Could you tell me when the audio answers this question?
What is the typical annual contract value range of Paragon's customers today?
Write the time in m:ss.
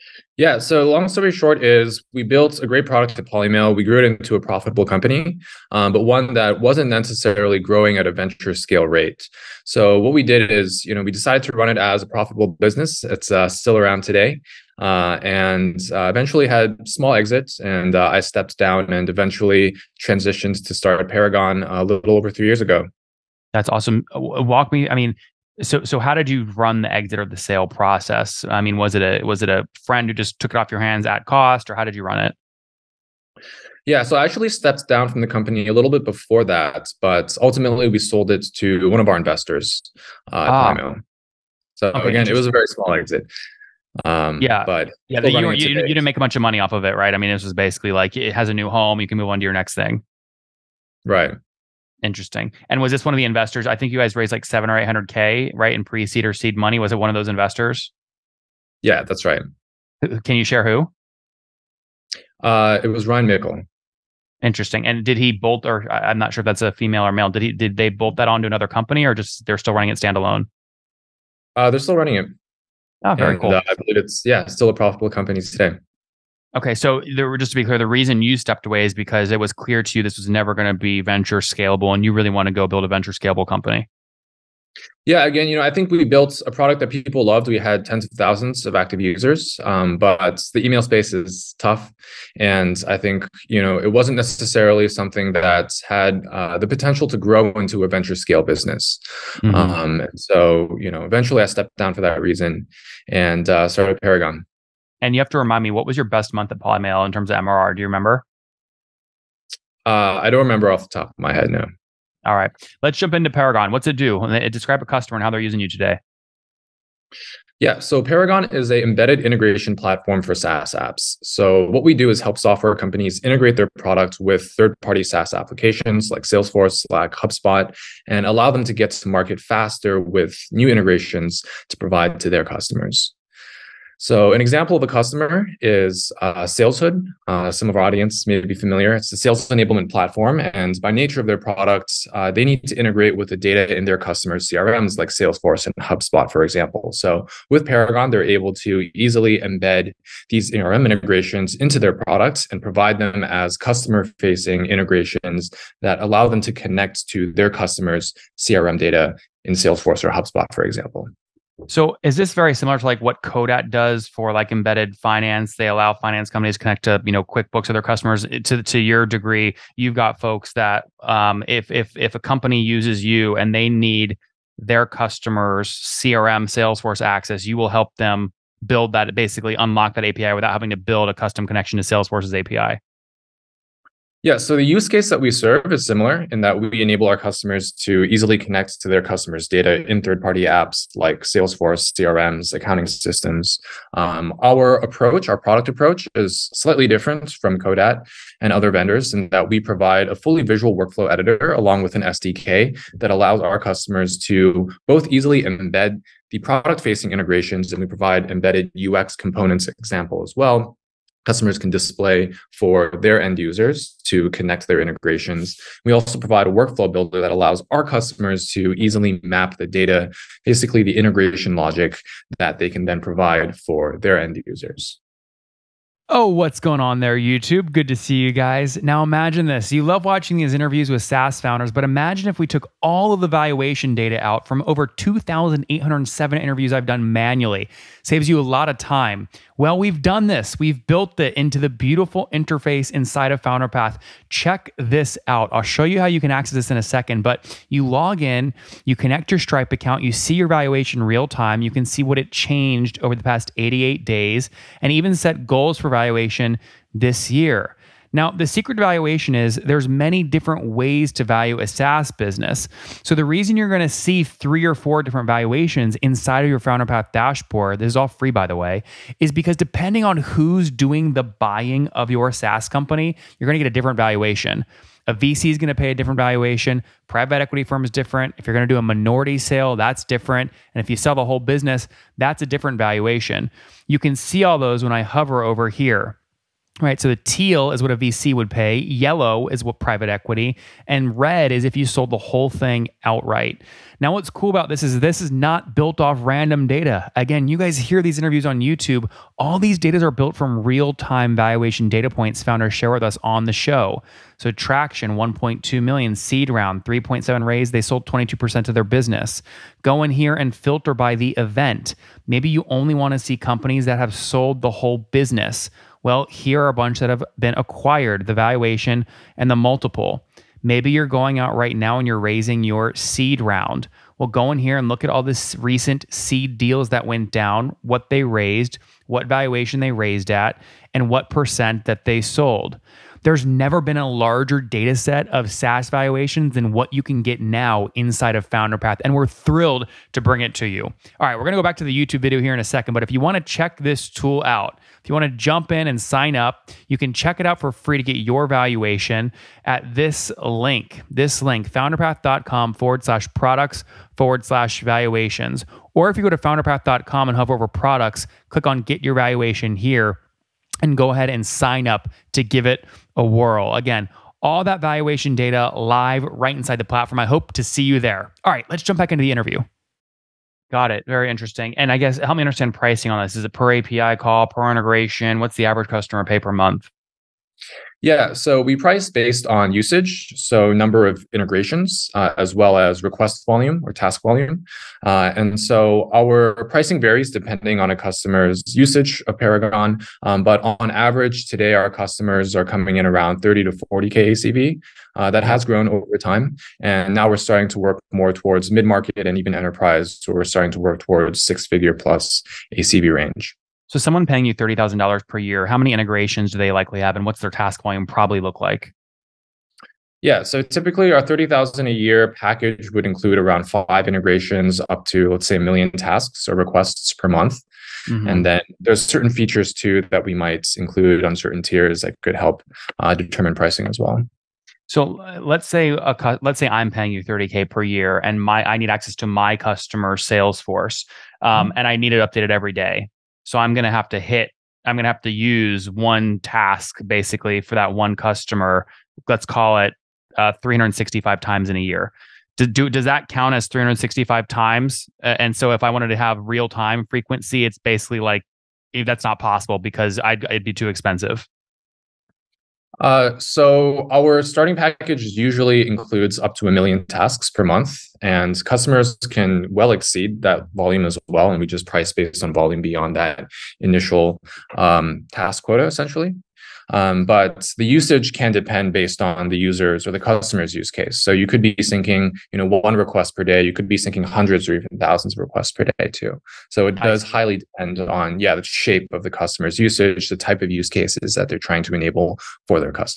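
6:33.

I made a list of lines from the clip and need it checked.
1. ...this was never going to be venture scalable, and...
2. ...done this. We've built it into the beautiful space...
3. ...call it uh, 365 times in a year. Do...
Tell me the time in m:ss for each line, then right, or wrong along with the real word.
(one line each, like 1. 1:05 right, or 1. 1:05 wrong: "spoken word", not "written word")
1. 1:20 right
2. 3:59 wrong: "interface", not "space"
3. 7:19 right.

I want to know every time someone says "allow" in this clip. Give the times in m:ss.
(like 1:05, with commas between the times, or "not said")
2:08, 2:36, 2:45, 3:23, 3:37.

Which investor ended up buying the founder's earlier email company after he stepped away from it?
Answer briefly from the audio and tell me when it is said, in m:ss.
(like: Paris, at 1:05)
Ryan Mickle, at 1:03.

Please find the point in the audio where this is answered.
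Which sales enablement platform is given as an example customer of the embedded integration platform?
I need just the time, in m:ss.
2:16.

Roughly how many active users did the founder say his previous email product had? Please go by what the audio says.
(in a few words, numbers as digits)
tens of thousands.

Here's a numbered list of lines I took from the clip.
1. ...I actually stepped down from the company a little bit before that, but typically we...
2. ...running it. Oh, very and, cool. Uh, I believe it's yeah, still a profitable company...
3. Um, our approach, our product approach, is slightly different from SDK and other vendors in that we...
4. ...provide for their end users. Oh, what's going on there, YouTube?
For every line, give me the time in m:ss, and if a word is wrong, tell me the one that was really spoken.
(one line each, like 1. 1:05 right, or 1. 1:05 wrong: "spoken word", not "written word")
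1. 0:34 wrong: "ultimately", not "typically"
2. 1:11 right
3. 3:13 wrong: "Codat", not "SDK"
4. 3:43 right.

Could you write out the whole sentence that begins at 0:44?
Um, yeah, but yeah, you, you, you, didn't make a bunch of money off of it, right?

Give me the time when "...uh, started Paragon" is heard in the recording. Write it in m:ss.
1:43.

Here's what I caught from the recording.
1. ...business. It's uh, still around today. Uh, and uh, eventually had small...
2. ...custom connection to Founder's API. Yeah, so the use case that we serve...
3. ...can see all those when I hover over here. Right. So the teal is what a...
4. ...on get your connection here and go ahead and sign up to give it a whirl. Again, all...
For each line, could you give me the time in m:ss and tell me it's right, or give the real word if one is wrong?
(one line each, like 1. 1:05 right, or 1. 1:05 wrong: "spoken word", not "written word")
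1. 0:12 right
2. 3:01 wrong: "Salesforce", not "Founder"
3. 4:43 right
4. 5:58 wrong: "valuation", not "connection".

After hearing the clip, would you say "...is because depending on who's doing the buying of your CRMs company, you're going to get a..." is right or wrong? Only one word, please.
wrong.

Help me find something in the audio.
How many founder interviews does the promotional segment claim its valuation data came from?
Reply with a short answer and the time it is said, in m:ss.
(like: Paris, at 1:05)
2,807, at 3:54.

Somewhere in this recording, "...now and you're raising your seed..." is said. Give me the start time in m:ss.
5:21.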